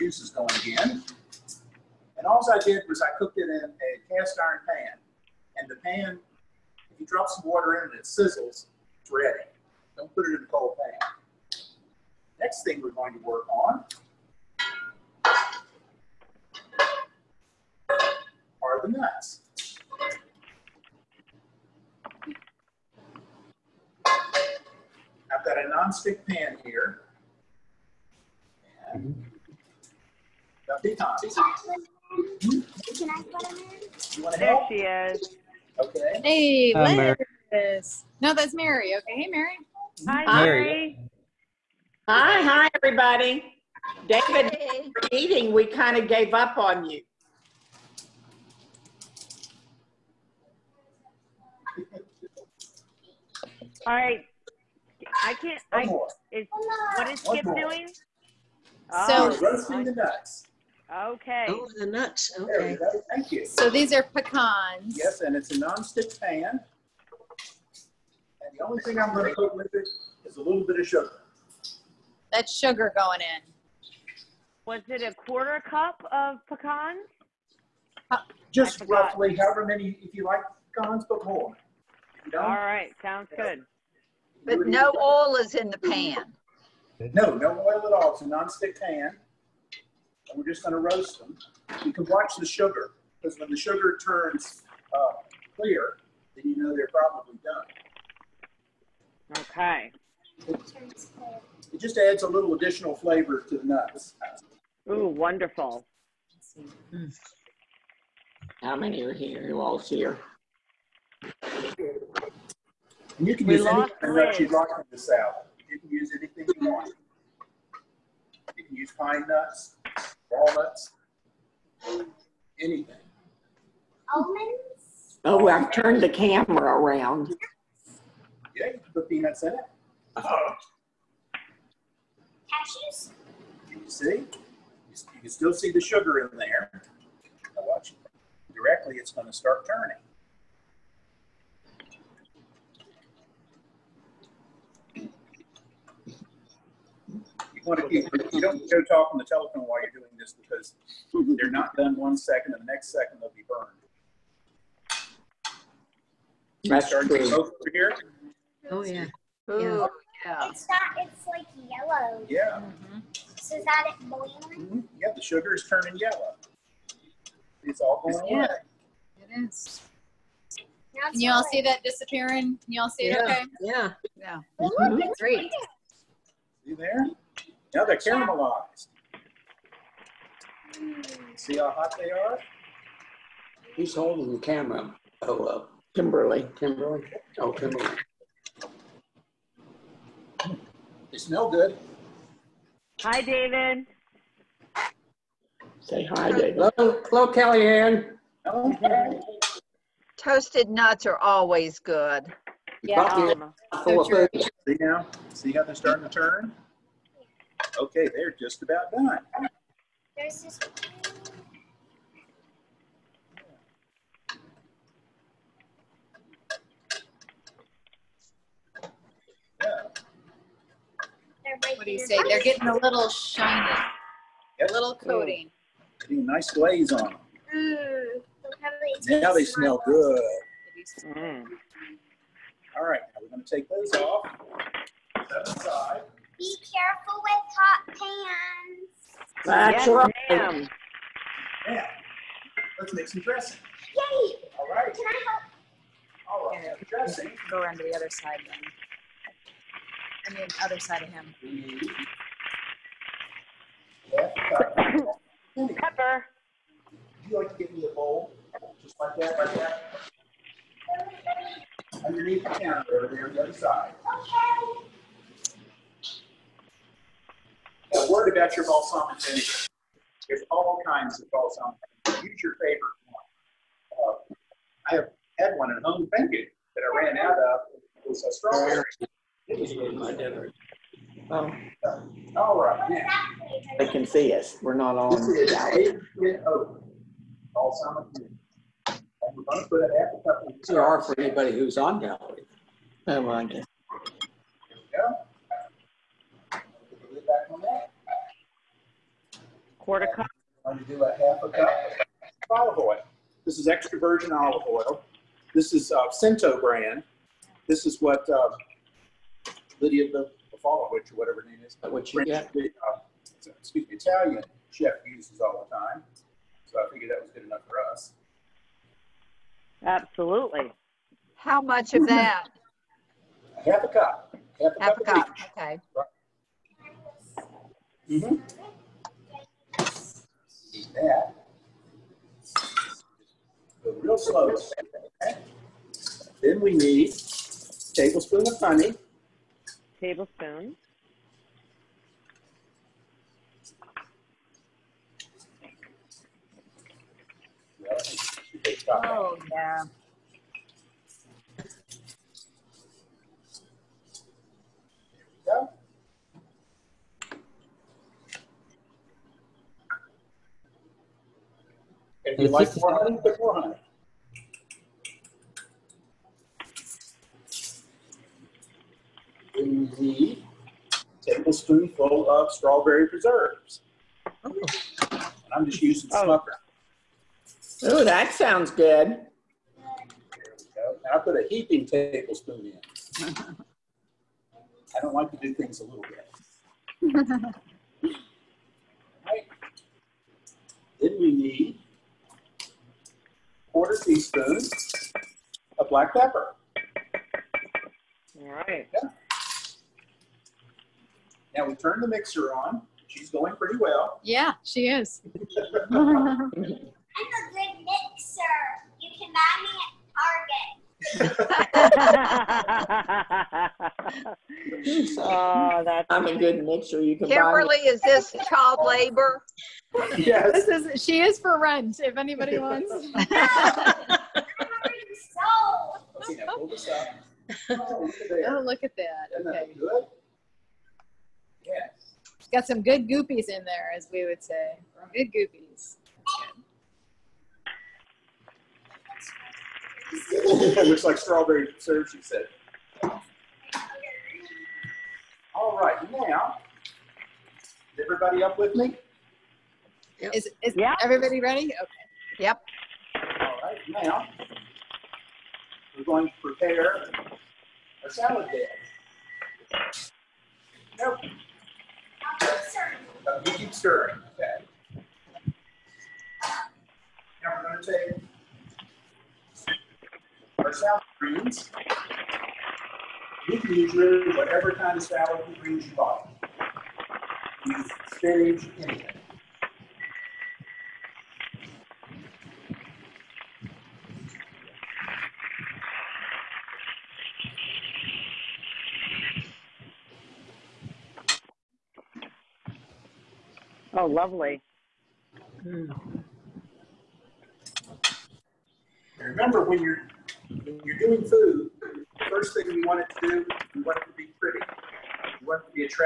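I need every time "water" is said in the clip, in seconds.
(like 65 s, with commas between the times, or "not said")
7 s.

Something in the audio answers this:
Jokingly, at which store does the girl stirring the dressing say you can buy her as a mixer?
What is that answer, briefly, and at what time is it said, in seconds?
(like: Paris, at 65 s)
Target, at 410 s.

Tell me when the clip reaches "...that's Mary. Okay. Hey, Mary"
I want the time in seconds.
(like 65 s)
38 s.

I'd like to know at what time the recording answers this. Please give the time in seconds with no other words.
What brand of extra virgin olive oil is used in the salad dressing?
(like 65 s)
306 s.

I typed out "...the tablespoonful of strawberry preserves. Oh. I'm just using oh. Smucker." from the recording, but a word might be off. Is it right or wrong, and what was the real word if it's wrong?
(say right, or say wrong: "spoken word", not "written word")
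right.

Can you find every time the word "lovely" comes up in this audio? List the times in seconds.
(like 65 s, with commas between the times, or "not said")
494 s.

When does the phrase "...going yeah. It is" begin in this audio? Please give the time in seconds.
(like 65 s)
168 s.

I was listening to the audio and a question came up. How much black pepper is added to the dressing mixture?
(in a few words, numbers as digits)
quarter teaspoon.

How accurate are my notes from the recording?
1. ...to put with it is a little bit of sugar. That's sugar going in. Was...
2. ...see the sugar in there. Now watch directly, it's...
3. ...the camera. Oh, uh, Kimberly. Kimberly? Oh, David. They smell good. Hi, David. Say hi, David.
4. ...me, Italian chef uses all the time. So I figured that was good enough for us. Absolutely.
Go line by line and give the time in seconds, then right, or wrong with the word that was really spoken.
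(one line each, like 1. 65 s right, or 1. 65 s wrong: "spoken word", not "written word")
1. 69 s right
2. 135 s right
3. 184 s wrong: "Kimberly", not "David"
4. 313 s right.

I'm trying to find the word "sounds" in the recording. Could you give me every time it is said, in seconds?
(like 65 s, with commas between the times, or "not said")
83 s, 378 s.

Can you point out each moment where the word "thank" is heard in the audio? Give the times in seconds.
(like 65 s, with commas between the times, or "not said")
63 s, 276 s.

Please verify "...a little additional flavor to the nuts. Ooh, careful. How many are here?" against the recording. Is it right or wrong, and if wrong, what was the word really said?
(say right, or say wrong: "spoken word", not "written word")
wrong: "wonderful", not "careful".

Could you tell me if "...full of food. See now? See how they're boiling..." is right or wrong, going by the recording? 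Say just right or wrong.
wrong.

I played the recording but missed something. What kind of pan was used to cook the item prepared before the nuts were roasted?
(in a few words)
cast iron pan.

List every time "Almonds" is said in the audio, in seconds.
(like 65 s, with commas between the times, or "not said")
124 s.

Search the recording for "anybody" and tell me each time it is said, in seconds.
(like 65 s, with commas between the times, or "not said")
291 s, 422 s.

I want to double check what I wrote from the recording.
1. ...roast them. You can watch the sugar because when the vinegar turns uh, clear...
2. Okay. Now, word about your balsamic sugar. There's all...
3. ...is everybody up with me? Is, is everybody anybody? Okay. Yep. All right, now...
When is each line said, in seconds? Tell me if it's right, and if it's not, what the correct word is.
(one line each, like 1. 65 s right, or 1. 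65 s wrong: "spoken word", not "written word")
1. 90 s wrong: "sugar", not "vinegar"
2. 264 s wrong: "vinegar", not "sugar"
3. 447 s wrong: "ready", not "anybody".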